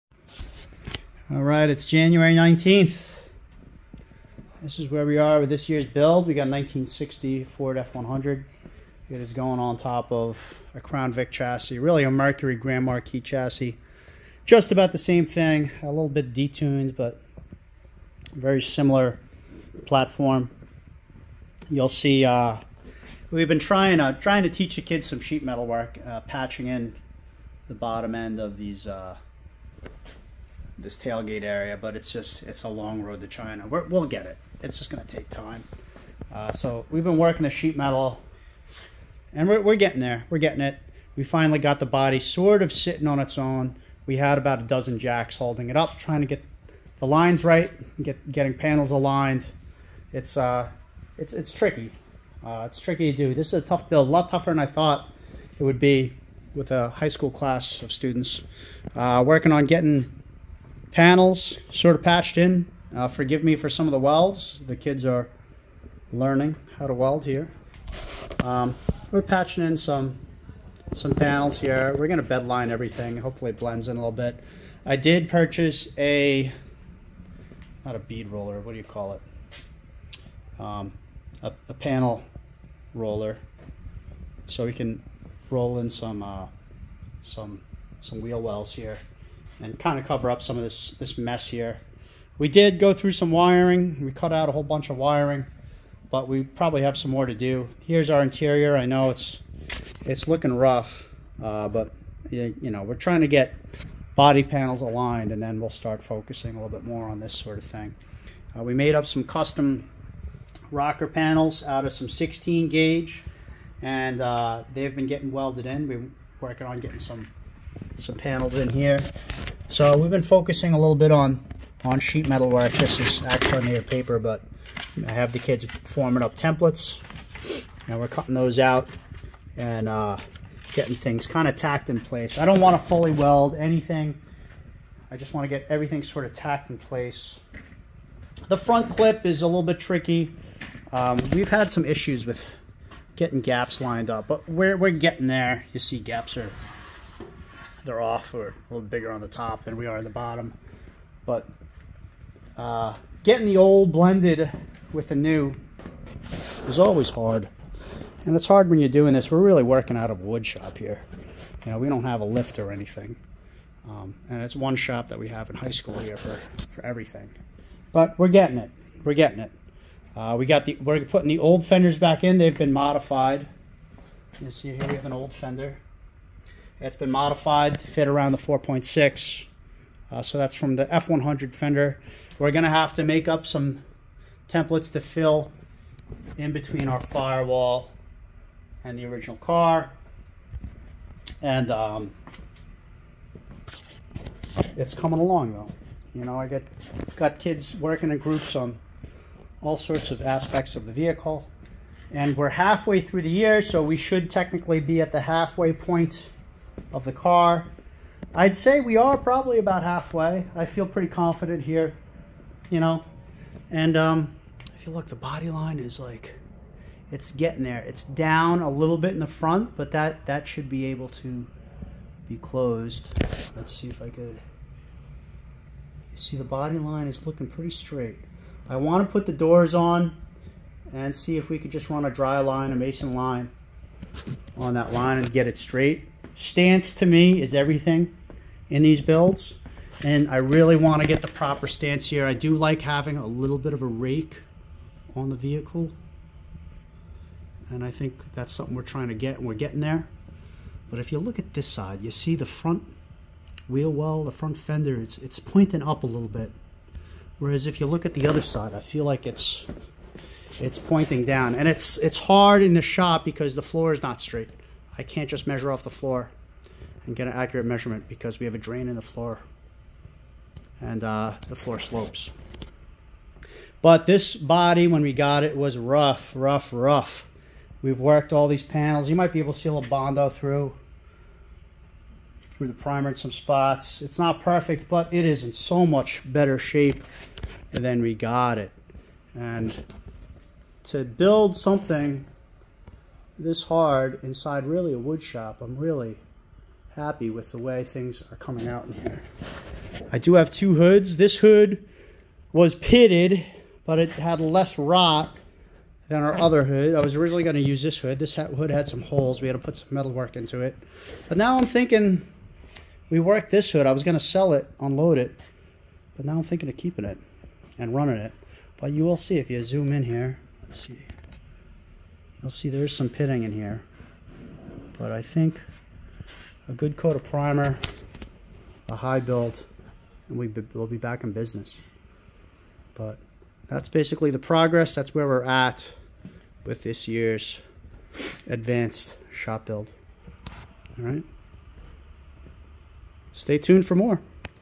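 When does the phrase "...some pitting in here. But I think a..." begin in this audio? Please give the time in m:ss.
5:22.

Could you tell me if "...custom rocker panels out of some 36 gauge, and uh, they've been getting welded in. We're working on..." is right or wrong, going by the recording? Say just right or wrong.
wrong.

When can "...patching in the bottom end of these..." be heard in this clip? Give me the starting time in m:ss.
0:26.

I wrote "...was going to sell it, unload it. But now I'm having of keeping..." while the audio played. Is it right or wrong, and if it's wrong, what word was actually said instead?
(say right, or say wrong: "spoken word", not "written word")
wrong: "thinking", not "having".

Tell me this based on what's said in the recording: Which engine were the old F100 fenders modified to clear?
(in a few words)
4.6.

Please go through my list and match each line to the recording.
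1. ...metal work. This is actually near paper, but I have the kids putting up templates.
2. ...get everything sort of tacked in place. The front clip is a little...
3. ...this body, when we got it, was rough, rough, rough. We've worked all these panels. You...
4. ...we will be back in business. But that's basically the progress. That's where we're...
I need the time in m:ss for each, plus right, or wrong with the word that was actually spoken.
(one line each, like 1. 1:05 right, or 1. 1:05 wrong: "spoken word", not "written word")
1. 2:02 wrong: "forming", not "putting"
2. 2:15 right
3. 4:34 right
4. 5:30 right.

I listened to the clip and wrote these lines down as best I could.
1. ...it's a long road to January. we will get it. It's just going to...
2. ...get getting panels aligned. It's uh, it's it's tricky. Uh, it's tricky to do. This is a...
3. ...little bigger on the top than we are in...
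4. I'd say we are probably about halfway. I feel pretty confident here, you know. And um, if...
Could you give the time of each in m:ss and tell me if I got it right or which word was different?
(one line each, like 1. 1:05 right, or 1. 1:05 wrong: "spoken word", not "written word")
1. 0:32 wrong: "China", not "January"
2. 0:48 right
3. 2:28 right
4. 3:28 right.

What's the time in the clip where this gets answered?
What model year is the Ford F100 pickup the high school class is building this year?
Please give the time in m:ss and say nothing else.
0:06.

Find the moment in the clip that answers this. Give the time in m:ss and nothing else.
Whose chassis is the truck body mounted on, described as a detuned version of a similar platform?
0:12.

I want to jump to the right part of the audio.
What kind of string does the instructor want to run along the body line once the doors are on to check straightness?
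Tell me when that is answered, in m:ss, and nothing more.
3:52.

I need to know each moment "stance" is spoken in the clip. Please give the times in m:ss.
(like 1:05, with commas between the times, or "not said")
3:56, 4:01.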